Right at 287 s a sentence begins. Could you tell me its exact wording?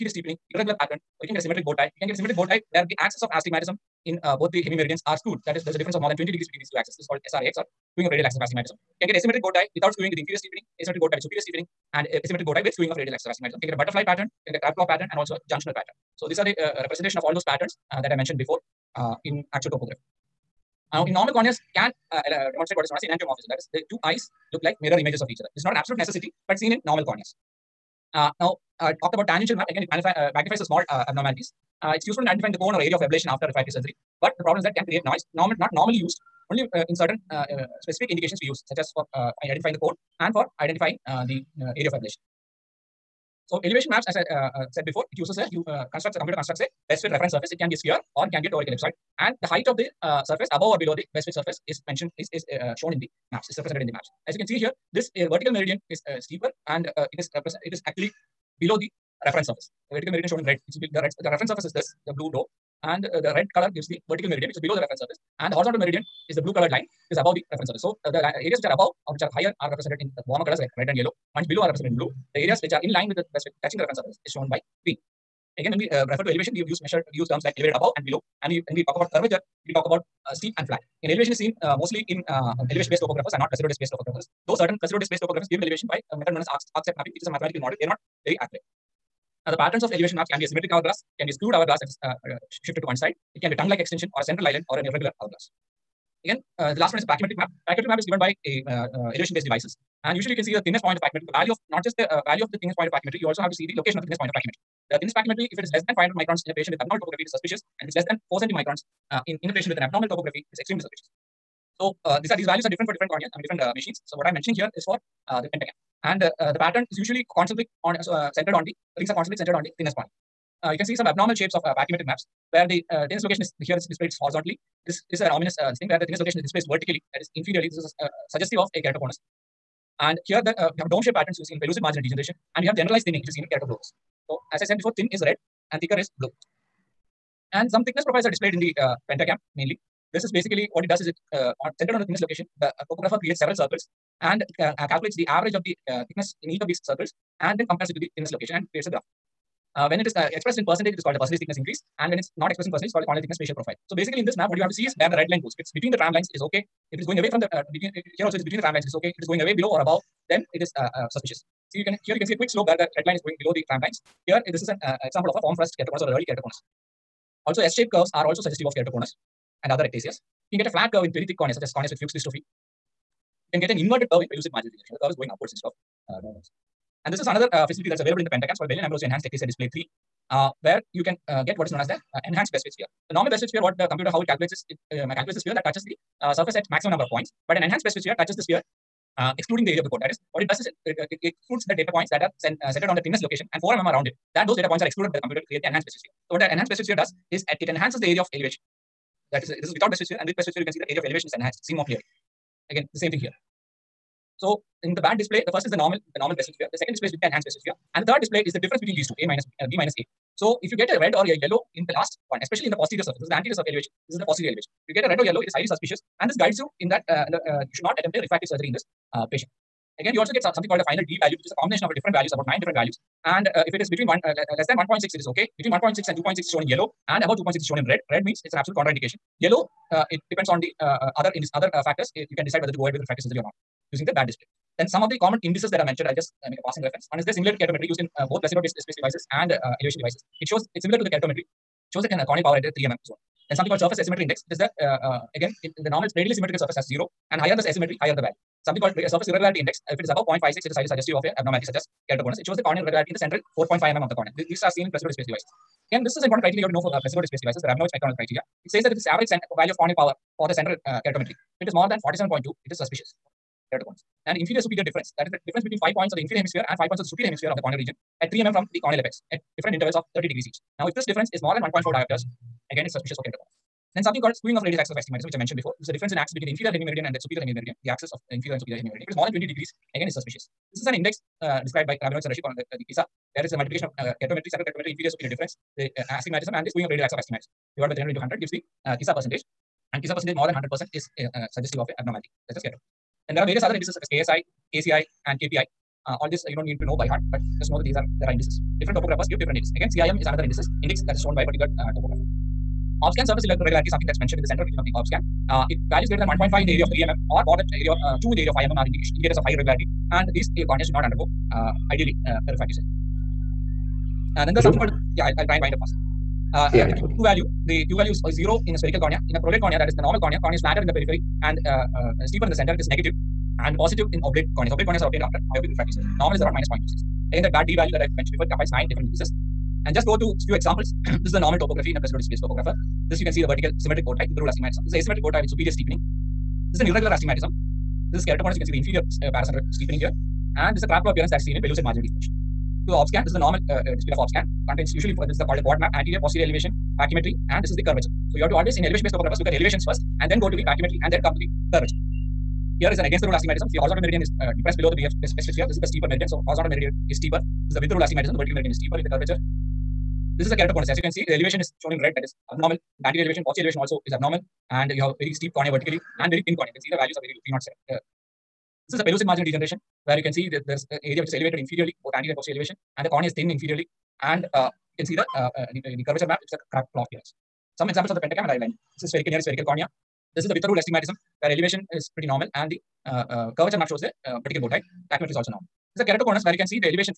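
Divided by 300 into 100 gives the KISA uh, percentage.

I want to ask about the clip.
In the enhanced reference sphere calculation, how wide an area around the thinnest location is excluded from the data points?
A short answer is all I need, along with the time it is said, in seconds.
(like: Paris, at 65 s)
4 mm, at 193 s.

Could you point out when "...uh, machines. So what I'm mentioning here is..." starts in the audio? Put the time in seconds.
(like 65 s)
113 s.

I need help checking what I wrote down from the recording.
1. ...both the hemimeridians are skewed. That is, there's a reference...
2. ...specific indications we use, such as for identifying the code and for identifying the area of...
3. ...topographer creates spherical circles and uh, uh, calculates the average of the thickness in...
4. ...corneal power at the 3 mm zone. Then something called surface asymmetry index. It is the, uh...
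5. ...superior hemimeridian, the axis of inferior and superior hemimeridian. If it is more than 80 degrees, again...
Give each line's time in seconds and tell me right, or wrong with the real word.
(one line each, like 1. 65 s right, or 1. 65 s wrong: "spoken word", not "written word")
1. 4 s wrong: "difference", not "reference"
2. 37 s right
3. 142 s wrong: "several", not "spherical"
4. 242 s right
5. 277 s wrong: "20", not "80".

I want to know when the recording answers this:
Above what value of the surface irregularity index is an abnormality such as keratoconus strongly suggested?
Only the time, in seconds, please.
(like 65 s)
250 s.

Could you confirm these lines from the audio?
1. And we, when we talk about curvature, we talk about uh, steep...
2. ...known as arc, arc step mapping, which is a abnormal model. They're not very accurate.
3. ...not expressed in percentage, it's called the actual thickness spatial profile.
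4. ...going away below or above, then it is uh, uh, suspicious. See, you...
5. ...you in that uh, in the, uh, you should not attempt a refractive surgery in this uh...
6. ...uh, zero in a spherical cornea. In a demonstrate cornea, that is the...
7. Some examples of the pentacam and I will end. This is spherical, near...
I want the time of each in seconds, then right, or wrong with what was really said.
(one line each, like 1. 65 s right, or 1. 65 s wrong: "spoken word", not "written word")
1. 78 s right
2. 86 s wrong: "mathematical", not "abnormal"
3. 152 s wrong: "corneal", not "actual"
4. 159 s right
5. 216 s right
6. 318 s wrong: "prolate", not "demonstrate"
7. 377 s right.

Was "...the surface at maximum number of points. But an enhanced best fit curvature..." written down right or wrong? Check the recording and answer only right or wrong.
wrong.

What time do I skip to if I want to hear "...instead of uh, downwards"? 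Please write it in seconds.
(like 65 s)
175 s.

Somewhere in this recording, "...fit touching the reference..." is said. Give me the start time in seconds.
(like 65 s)
73 s.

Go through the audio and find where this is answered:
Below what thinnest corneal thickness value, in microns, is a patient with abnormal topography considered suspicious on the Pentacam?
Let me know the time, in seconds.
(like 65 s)
105 s.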